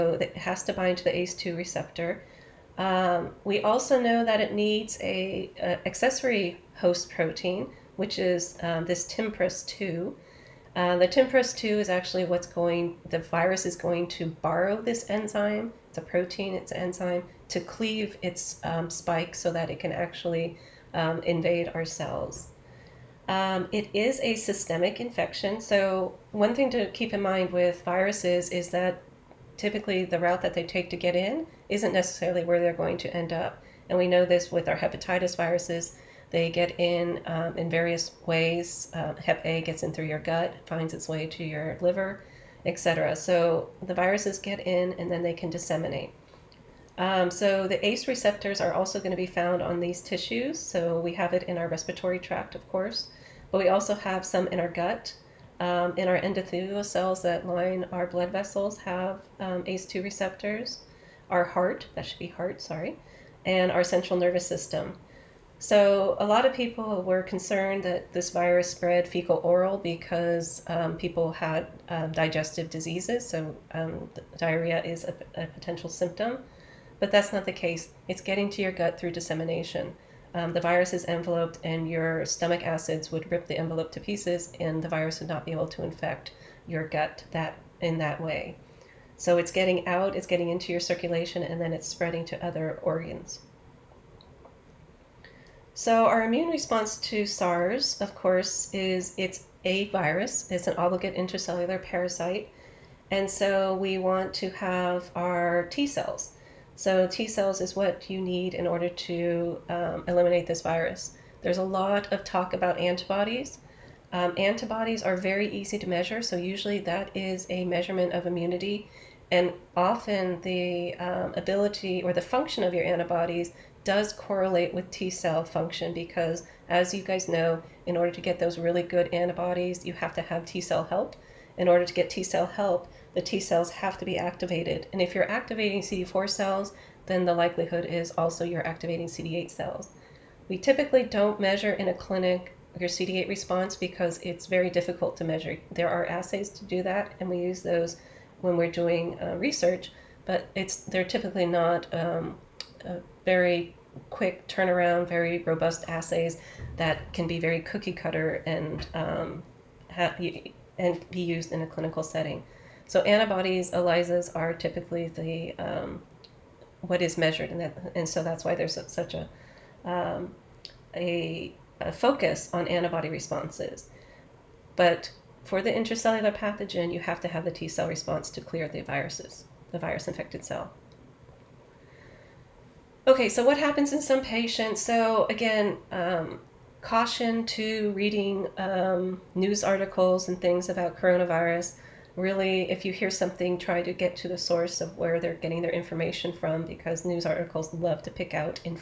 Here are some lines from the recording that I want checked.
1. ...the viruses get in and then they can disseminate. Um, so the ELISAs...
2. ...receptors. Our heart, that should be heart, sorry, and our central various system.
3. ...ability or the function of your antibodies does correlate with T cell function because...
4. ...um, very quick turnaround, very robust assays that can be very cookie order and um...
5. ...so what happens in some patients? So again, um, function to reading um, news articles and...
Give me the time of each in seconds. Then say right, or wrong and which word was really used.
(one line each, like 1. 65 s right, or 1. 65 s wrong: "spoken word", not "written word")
1. 43 s wrong: "ACE", not "ELISAs"
2. 60 s wrong: "nervous", not "various"
3. 121 s right
4. 151 s wrong: "cutter", not "order"
5. 183 s wrong: "caution", not "function".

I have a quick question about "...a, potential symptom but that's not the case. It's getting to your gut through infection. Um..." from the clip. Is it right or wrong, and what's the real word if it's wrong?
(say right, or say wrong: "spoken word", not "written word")
wrong: "dissemination", not "infection".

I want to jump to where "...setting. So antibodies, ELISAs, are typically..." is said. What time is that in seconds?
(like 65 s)
162 s.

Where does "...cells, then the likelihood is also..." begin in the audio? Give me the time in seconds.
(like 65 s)
136 s.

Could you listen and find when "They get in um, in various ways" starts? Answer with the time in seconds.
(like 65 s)
36 s.